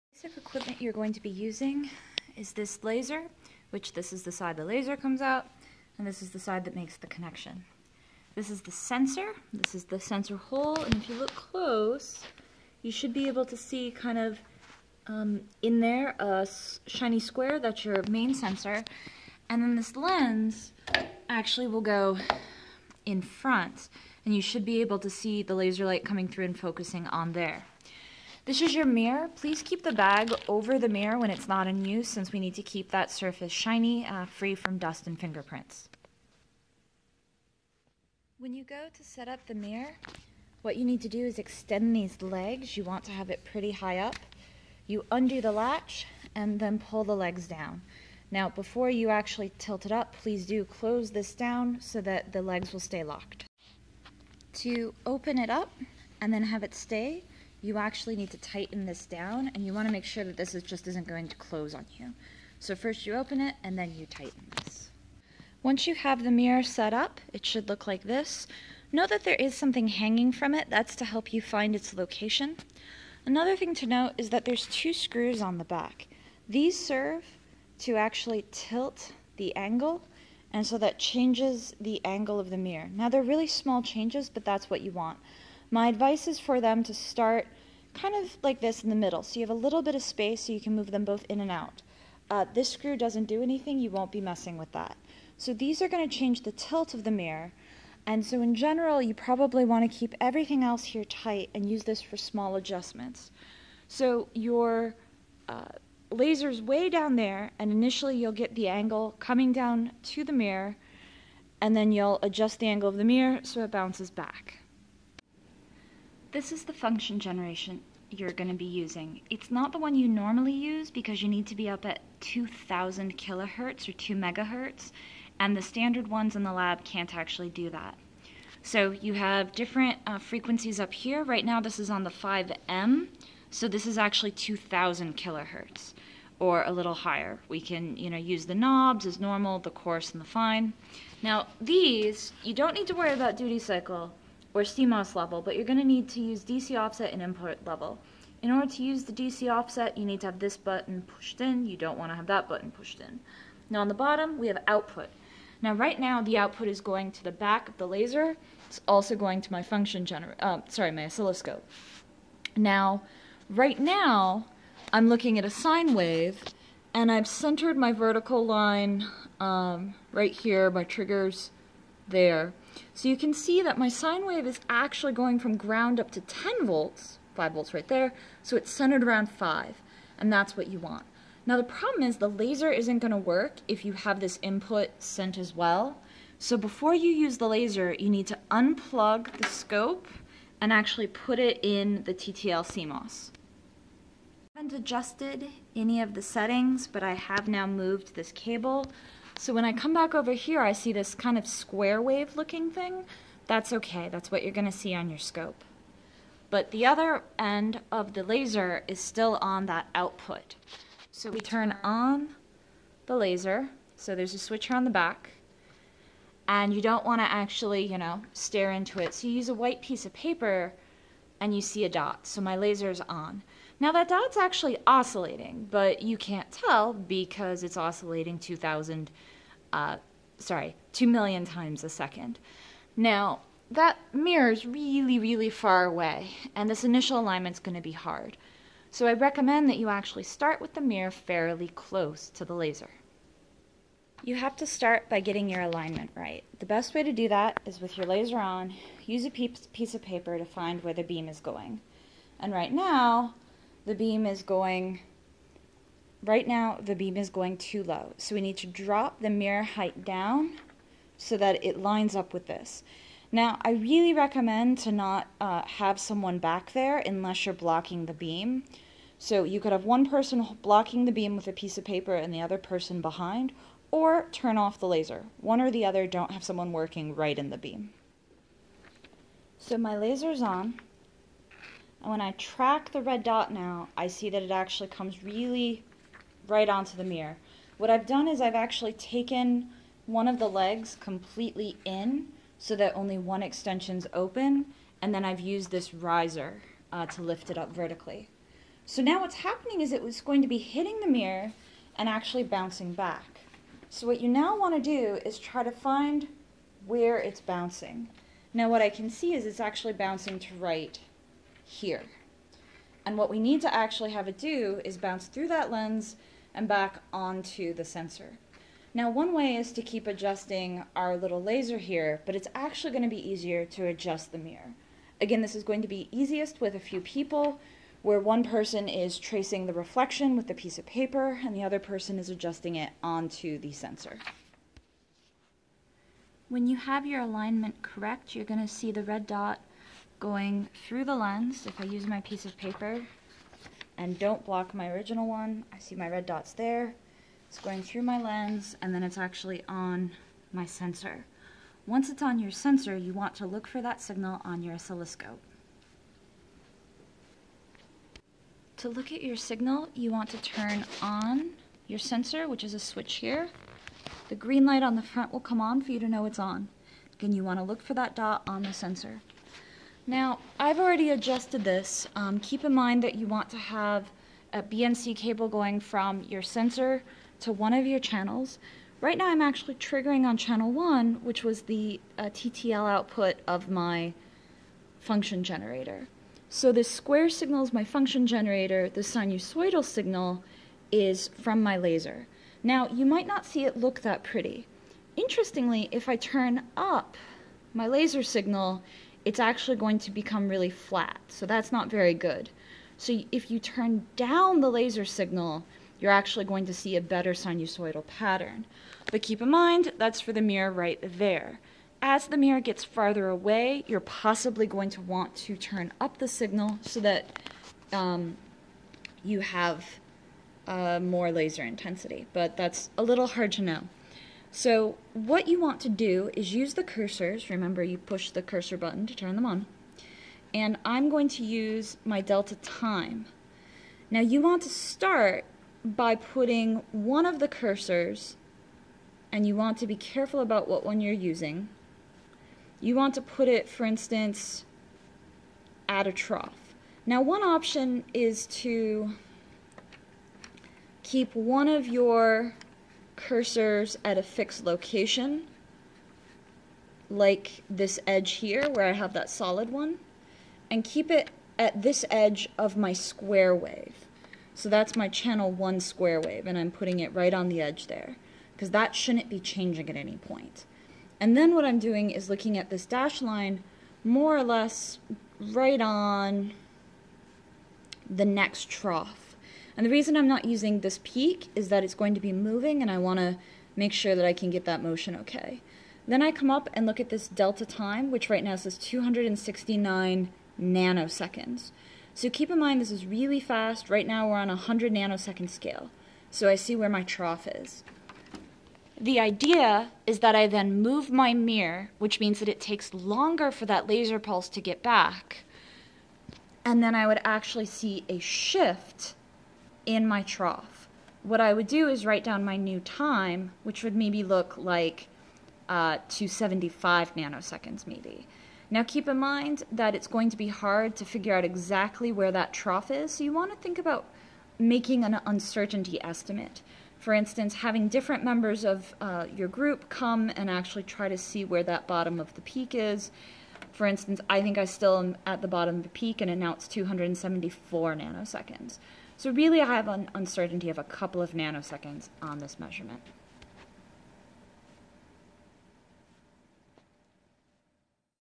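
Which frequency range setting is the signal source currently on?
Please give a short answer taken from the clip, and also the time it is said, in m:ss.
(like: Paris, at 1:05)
5M, at 2:12.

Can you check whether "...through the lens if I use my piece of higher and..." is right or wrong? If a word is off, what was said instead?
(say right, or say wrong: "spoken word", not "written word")
wrong: "paper", not "higher".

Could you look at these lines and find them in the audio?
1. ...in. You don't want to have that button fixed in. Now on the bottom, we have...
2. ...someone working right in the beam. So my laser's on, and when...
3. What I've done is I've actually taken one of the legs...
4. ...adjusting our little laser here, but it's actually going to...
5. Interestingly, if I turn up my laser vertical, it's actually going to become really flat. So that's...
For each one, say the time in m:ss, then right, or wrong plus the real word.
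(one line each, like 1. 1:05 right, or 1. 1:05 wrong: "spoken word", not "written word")
1. 2:31 wrong: "pushed", not "fixed"
2. 4:36 right
3. 4:47 right
4. 5:20 right
5. 6:35 wrong: "signal", not "vertical".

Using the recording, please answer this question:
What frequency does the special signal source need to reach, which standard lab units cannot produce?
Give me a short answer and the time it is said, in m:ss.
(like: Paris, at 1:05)
2 megahertz, at 2:03.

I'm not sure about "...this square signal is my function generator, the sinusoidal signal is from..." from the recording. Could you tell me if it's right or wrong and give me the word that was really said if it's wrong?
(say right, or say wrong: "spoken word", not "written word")
right.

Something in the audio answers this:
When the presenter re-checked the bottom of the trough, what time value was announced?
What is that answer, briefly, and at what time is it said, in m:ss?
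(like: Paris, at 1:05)
274 nanoseconds, at 8:56.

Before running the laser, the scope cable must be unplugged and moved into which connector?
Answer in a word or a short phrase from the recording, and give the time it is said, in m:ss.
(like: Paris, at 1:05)
TTL CMOS, at 3:12.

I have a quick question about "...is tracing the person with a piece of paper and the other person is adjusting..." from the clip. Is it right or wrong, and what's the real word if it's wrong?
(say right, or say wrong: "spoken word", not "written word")
wrong: "reflection", not "person".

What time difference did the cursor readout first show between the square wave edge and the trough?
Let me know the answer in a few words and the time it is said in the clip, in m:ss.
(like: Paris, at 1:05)
269 nanoseconds, at 8:08.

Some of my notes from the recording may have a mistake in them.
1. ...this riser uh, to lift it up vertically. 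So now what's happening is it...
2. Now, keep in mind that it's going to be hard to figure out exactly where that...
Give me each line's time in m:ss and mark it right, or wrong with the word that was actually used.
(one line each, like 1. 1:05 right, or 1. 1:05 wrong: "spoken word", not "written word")
1. 4:55 right
2. 8:38 right.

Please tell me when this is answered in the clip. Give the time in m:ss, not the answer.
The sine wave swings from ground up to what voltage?
2:56.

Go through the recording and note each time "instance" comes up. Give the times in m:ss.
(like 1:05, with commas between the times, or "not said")
7:23, 8:47, 8:53.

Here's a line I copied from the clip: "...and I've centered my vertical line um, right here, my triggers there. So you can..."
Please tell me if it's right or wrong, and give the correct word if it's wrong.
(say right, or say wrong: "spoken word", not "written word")
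right.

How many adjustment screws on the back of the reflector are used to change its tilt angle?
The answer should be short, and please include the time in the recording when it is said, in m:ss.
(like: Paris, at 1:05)
2, at 1:14.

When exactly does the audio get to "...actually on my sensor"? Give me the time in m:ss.
5:49.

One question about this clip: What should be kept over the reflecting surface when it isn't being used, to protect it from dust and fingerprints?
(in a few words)
The bag.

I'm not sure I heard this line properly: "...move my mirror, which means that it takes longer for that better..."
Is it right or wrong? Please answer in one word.
wrong.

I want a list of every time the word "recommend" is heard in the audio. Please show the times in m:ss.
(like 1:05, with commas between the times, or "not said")
3:59, 4:24.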